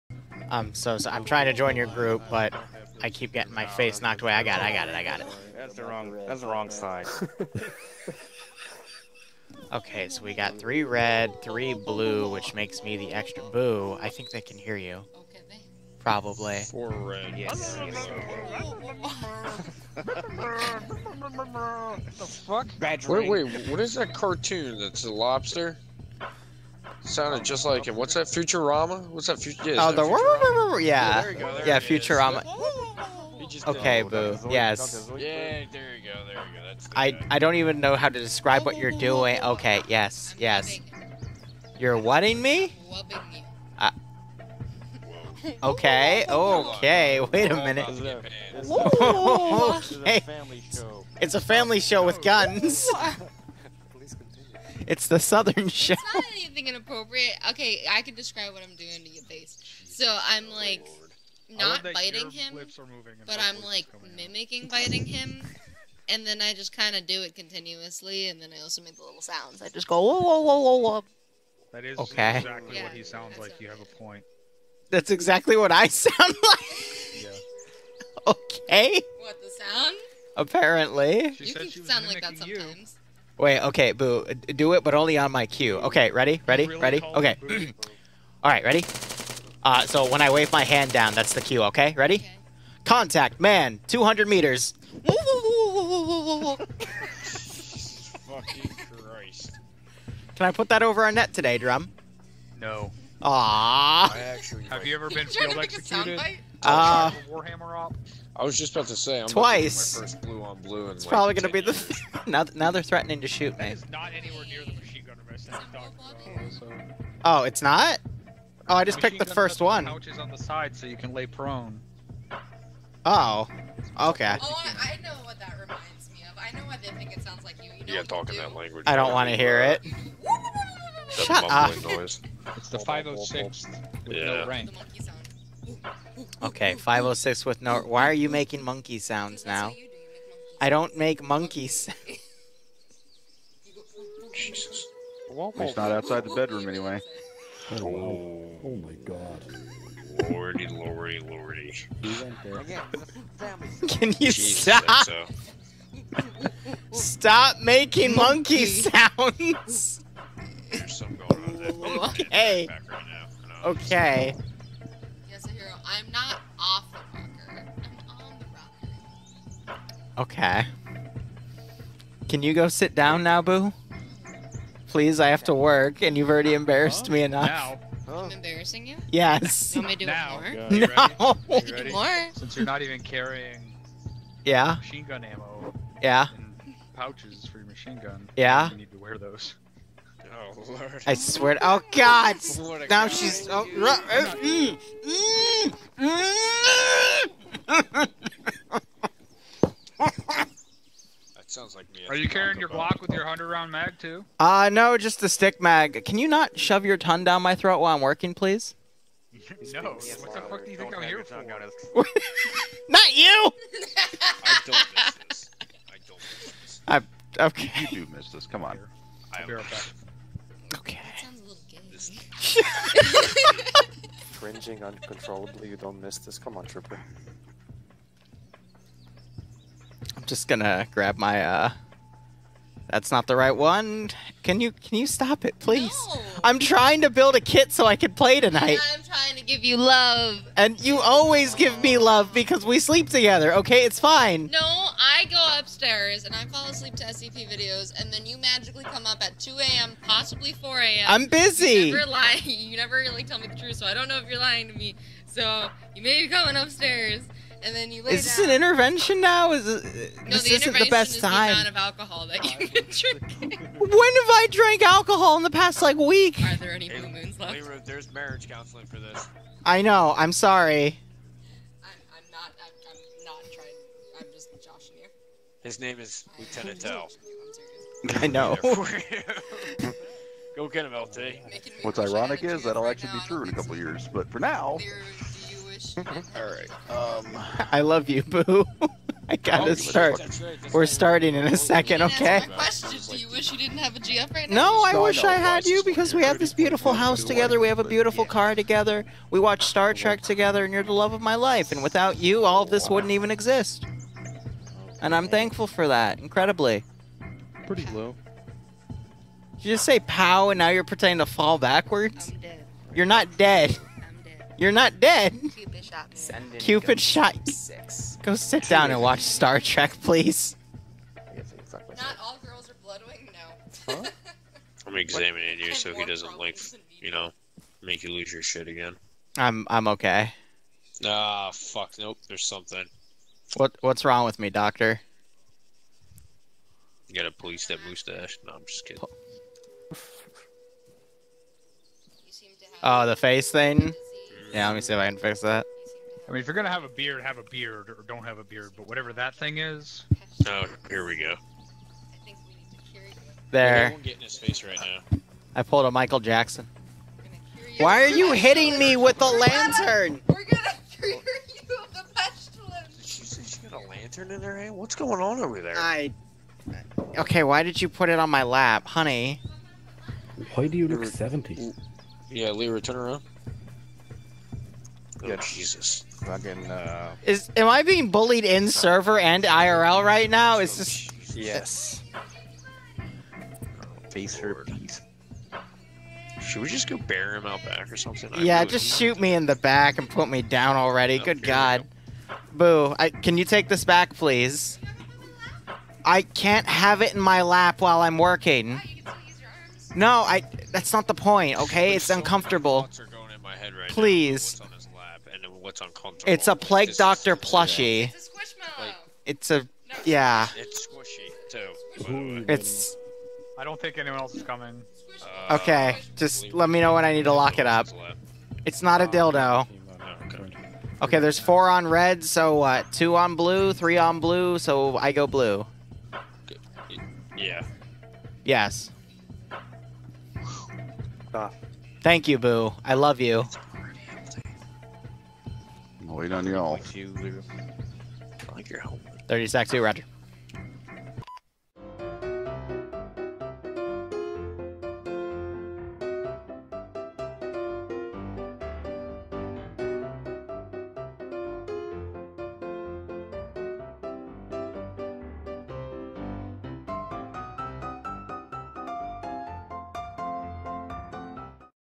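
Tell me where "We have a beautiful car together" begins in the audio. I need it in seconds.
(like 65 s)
297 s.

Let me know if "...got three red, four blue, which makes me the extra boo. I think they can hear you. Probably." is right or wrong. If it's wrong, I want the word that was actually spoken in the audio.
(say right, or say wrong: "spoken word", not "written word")
wrong: "three", not "four".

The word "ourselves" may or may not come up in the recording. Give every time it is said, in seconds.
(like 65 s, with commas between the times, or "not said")
not said.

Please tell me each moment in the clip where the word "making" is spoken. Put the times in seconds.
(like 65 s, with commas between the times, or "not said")
138 s, 157 s.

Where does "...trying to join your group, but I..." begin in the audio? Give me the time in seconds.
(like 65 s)
1 s.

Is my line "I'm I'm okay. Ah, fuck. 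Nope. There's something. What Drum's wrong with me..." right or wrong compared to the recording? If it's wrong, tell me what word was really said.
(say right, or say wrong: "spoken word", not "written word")
wrong: "What", not "Drum".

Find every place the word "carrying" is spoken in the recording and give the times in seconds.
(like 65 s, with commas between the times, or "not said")
183 s, 202 s.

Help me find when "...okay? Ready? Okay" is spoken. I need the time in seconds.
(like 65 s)
91 s.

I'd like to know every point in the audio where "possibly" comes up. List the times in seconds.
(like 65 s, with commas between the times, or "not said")
250 s.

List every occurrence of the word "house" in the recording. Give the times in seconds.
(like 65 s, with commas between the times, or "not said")
296 s.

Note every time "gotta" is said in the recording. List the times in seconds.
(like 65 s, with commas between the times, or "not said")
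289 s, 337 s.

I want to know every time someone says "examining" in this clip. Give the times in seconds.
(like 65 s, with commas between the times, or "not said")
324 s.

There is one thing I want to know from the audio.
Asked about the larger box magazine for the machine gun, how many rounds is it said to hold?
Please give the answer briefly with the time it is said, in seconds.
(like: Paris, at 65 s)
100, at 203 s.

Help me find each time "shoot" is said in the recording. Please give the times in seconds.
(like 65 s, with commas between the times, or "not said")
113 s, 388 s.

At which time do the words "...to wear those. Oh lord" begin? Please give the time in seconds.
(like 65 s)
188 s.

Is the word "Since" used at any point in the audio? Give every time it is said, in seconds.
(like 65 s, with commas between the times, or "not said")
182 s.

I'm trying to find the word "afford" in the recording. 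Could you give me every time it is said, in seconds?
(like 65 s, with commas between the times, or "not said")
not said.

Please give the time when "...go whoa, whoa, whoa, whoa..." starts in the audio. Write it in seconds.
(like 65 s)
69 s.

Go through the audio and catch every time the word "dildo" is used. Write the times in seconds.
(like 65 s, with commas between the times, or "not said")
419 s.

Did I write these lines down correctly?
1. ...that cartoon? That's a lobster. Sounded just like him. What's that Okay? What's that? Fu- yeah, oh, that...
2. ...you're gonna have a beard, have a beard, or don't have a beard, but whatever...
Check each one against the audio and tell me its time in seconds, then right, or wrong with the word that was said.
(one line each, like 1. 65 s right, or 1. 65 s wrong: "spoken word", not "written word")
1. 23 s wrong: "Futurama", not "Okay"
2. 346 s right.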